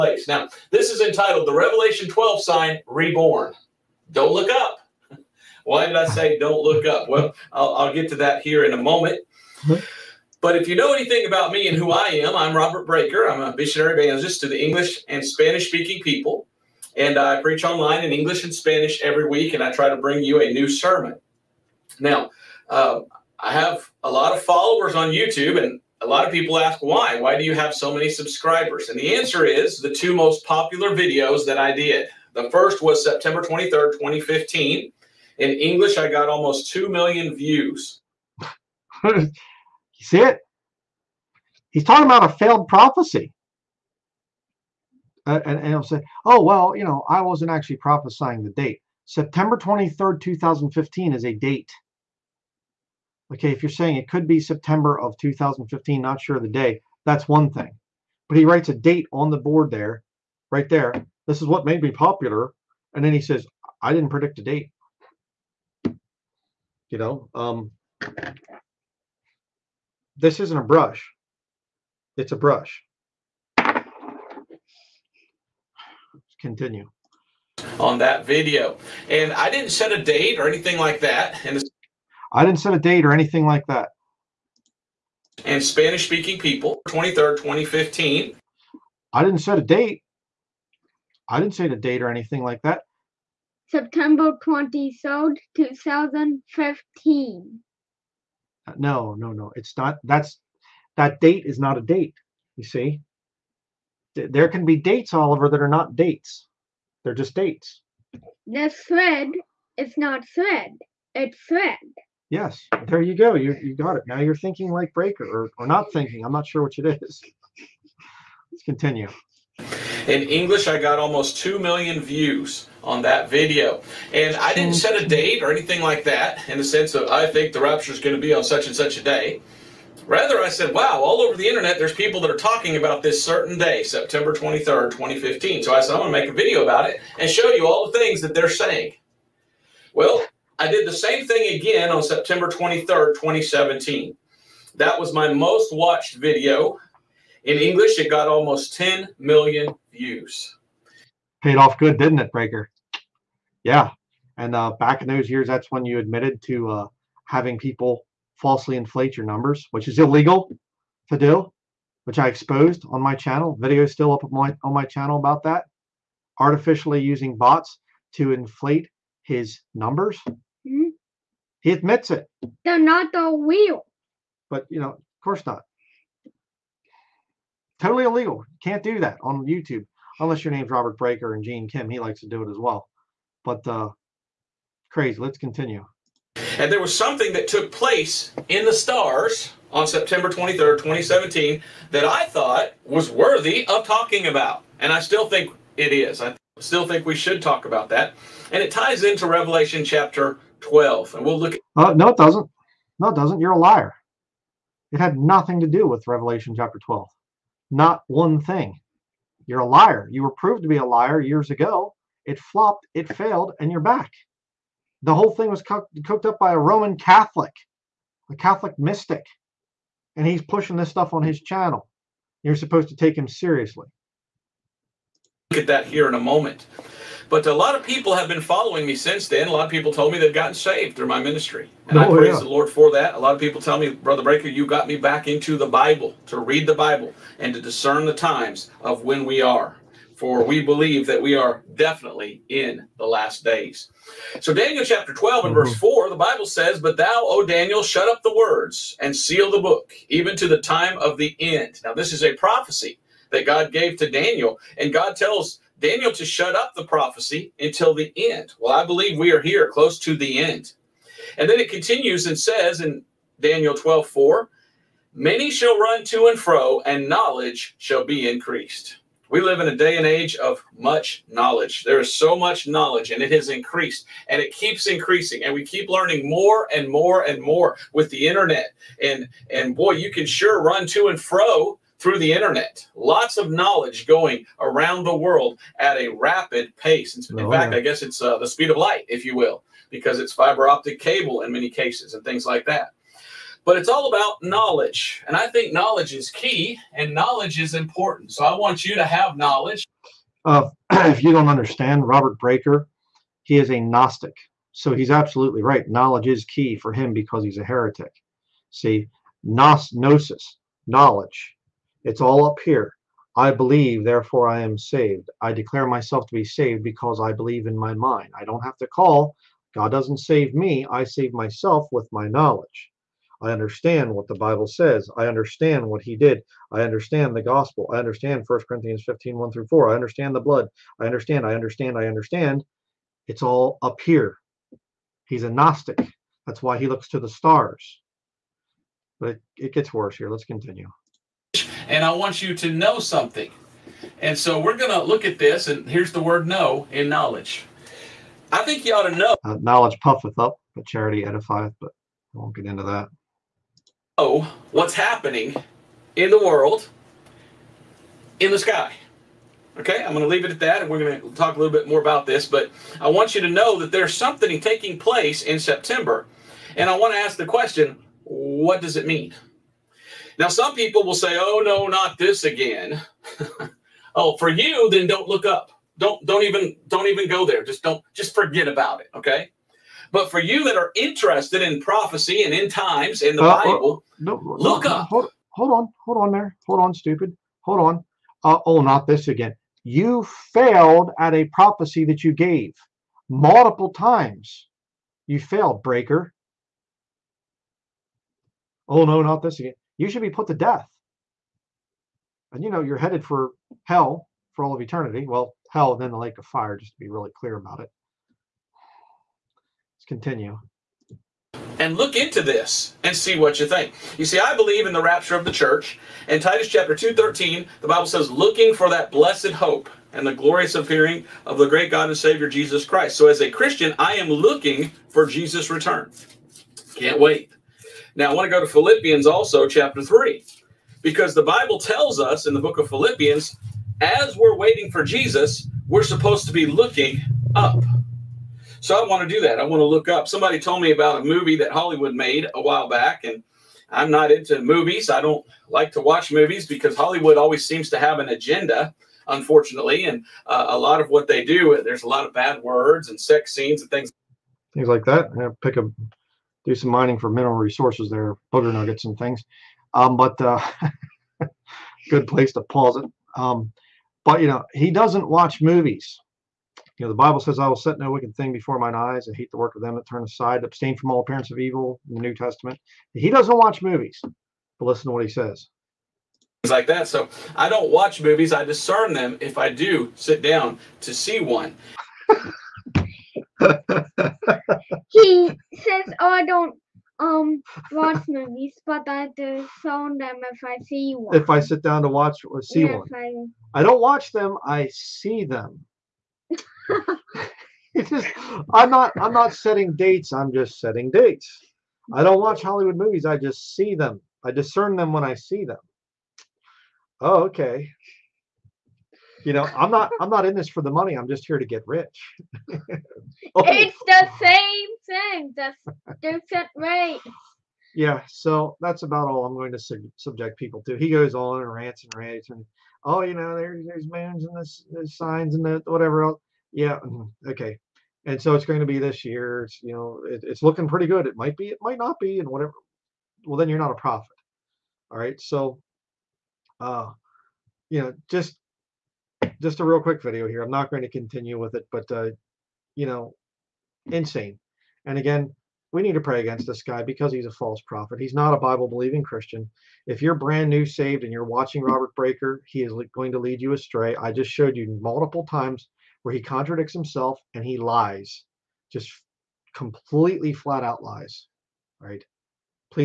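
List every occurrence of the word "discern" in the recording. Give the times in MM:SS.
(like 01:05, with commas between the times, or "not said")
03:57, 07:58, 08:24.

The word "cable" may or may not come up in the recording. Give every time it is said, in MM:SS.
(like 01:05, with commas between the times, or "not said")
04:50.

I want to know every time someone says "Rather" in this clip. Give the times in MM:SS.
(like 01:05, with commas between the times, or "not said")
02:10.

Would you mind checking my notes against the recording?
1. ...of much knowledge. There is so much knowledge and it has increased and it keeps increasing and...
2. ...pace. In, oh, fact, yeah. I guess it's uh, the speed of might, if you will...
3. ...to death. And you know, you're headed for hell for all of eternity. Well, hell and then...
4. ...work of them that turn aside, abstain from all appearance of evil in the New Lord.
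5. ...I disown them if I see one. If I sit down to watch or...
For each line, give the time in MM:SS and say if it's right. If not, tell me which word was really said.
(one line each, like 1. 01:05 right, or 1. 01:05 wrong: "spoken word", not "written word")
1. 04:30 right
2. 04:46 wrong: "light", not "might"
3. 06:40 right
4. 07:49 wrong: "Testament", not "Lord"
5. 08:09 right.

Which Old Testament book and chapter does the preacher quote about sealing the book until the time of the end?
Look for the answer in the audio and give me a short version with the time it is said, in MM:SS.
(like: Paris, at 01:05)
Daniel chapter 12, at 04:04.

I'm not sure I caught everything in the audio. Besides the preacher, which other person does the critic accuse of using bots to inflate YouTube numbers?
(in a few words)
Gene Kim.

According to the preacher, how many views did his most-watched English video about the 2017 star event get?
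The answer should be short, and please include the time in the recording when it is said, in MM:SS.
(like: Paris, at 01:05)
almost 10 million, at 02:28.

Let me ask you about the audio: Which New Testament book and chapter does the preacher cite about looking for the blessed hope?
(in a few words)
Titus chapter 2.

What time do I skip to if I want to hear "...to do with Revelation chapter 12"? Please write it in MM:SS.
03:25.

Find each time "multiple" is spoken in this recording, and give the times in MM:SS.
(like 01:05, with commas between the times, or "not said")
06:33, 09:15.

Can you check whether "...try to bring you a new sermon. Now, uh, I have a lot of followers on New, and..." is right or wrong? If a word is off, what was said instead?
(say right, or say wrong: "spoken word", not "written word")
wrong: "YouTube", not "New".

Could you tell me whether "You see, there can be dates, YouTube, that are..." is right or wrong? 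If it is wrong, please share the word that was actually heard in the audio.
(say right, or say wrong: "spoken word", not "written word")
wrong: "Oliver", not "YouTube".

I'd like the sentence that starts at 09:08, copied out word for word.
He's not a Bible believing Christian.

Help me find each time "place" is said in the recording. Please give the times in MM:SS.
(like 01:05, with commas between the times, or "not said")
03:07, 06:04, 07:42.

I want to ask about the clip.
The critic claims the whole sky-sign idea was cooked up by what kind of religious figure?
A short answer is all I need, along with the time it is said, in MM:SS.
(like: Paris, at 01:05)
a Catholic mystic, at 03:38.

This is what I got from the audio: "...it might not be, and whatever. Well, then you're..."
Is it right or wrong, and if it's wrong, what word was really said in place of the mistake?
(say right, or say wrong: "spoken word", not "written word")
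right.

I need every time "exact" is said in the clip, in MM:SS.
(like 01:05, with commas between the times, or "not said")
not said.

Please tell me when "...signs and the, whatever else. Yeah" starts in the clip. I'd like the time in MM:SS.
08:45.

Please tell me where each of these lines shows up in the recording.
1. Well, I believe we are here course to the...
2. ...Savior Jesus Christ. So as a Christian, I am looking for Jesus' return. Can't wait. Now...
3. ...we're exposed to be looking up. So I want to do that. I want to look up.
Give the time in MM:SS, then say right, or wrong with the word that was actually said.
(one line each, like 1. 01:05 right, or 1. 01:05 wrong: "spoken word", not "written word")
1. 04:18 wrong: "close", not "course"
2. 07:02 right
3. 07:15 wrong: "supposed", not "exposed".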